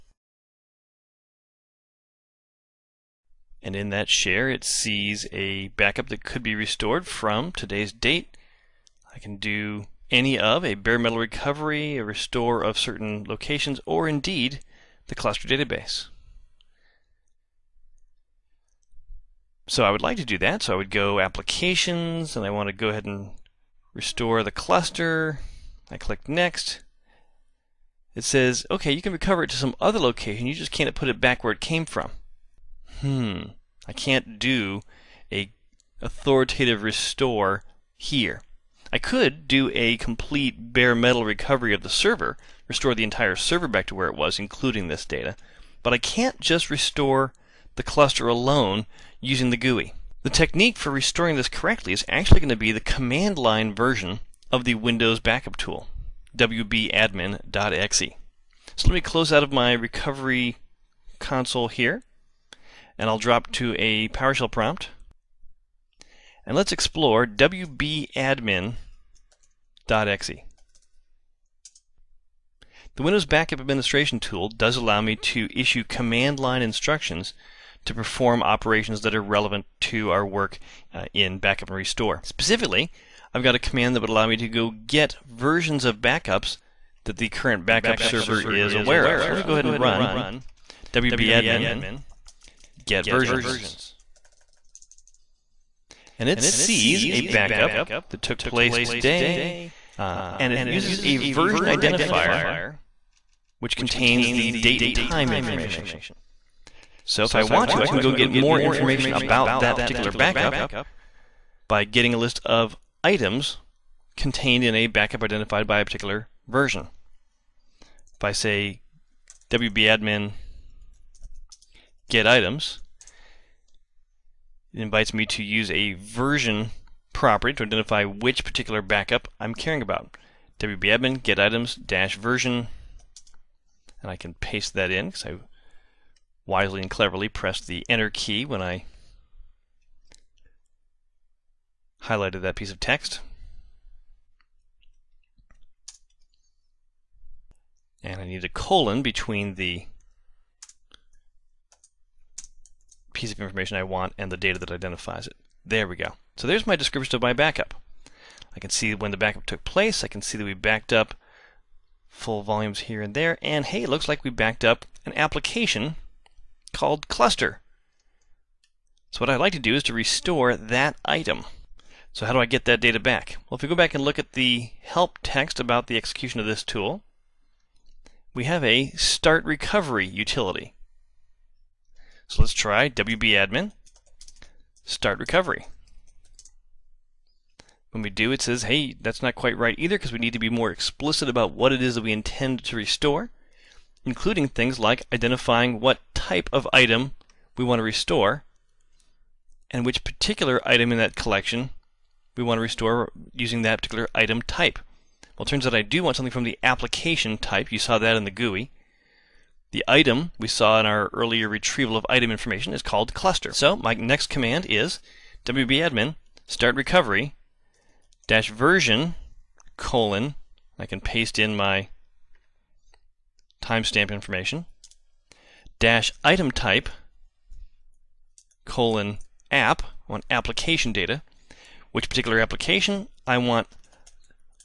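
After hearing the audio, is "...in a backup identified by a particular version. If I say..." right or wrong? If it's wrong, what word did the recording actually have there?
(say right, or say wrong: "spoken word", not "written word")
right.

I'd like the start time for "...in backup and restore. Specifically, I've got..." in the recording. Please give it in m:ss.
1:21.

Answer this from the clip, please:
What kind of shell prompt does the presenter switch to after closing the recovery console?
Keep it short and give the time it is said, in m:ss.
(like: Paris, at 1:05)
PowerShell, at 1:04.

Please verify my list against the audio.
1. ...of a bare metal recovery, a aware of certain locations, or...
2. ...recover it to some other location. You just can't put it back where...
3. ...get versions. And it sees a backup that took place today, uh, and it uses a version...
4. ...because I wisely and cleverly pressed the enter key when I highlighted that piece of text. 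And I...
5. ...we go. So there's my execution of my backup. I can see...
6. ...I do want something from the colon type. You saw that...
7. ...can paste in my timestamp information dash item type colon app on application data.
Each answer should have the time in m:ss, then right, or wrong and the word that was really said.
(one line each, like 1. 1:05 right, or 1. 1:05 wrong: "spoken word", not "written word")
1. 0:10 wrong: "restore", not "aware"
2. 0:29 right
3. 1:32 right
4. 2:15 right
5. 2:35 wrong: "description", not "execution"
6. 3:25 wrong: "application", not "colon"
7. 3:40 right.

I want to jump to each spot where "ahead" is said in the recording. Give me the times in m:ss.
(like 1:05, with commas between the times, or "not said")
0:22, 1:29.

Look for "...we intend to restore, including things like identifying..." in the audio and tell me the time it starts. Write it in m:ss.
3:12.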